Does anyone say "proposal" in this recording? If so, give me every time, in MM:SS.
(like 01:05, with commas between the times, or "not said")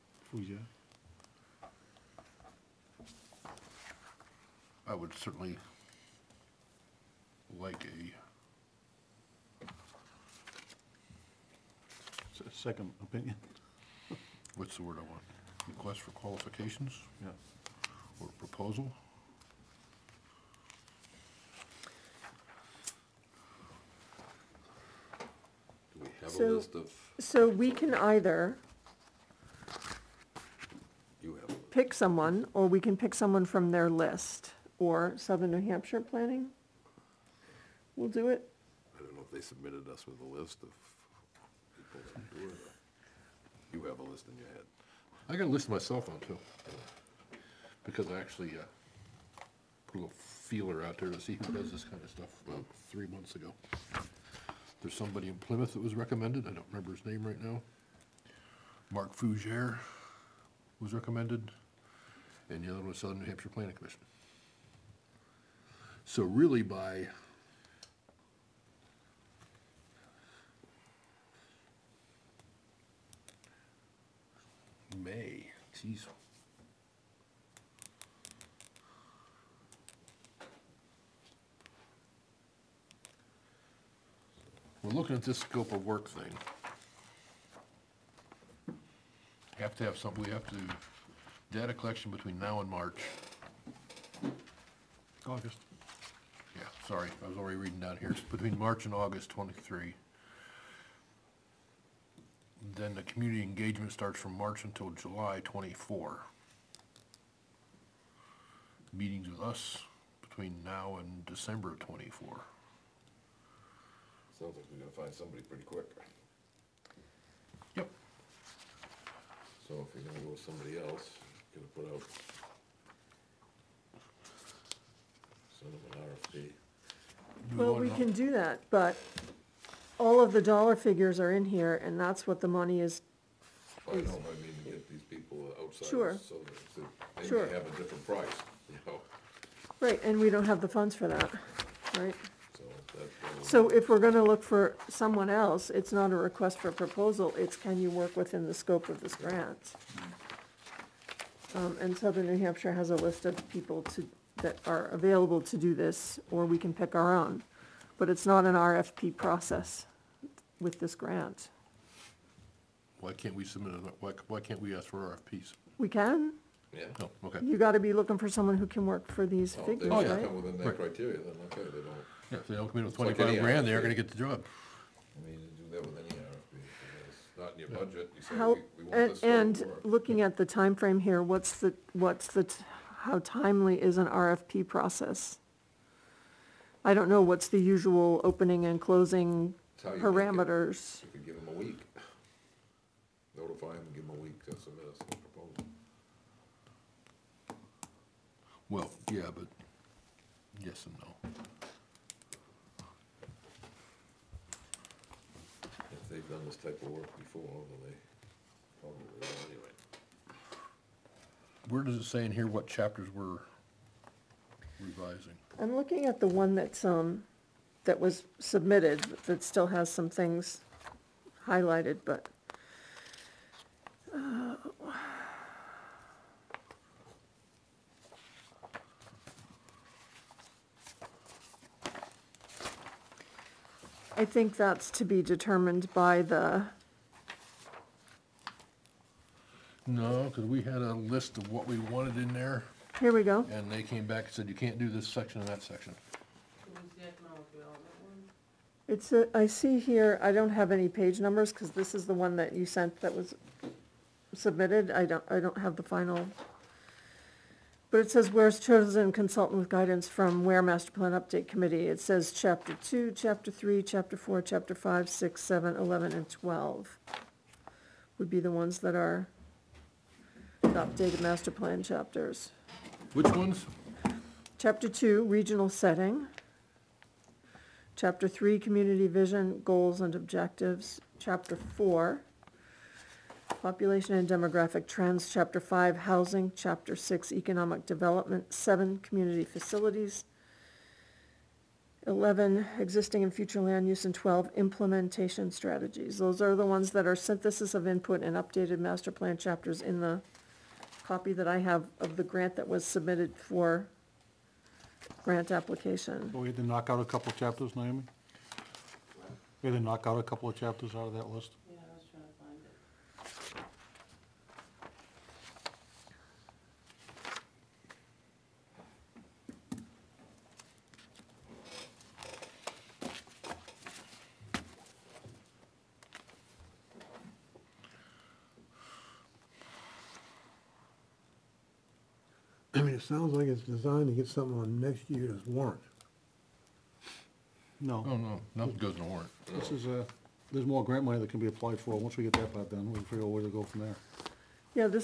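00:18, 02:26, 03:15.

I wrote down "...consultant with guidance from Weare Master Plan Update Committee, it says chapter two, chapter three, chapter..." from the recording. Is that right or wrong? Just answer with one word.
right.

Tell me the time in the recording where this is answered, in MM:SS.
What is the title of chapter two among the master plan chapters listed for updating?
04:35.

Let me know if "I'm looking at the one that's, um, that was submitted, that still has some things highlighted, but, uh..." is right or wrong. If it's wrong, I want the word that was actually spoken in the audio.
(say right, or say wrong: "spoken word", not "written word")
right.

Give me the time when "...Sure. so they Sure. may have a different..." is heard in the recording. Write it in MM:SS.
02:15.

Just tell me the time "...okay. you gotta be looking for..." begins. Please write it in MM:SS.
02:47.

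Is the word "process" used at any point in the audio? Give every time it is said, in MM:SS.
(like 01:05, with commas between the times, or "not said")
02:39, 03:04.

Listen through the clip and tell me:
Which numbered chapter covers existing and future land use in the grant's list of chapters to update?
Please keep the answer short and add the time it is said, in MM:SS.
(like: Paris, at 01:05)
11, at 04:52.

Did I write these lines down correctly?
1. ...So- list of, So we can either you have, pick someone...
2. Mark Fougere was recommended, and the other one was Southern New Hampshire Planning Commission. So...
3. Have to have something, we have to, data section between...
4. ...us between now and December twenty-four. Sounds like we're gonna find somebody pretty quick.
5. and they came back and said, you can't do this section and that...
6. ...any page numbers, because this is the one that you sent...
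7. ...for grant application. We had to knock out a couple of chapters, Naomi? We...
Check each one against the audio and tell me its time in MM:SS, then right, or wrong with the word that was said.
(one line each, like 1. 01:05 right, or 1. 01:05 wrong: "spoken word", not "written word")
1. 00:26 right
2. 00:58 right
3. 01:29 wrong: "collection", not "section"
4. 01:49 right
5. 04:03 right
6. 04:10 right
7. 05:03 right.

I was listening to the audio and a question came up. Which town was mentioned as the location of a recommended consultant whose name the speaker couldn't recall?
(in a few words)
Plymouth.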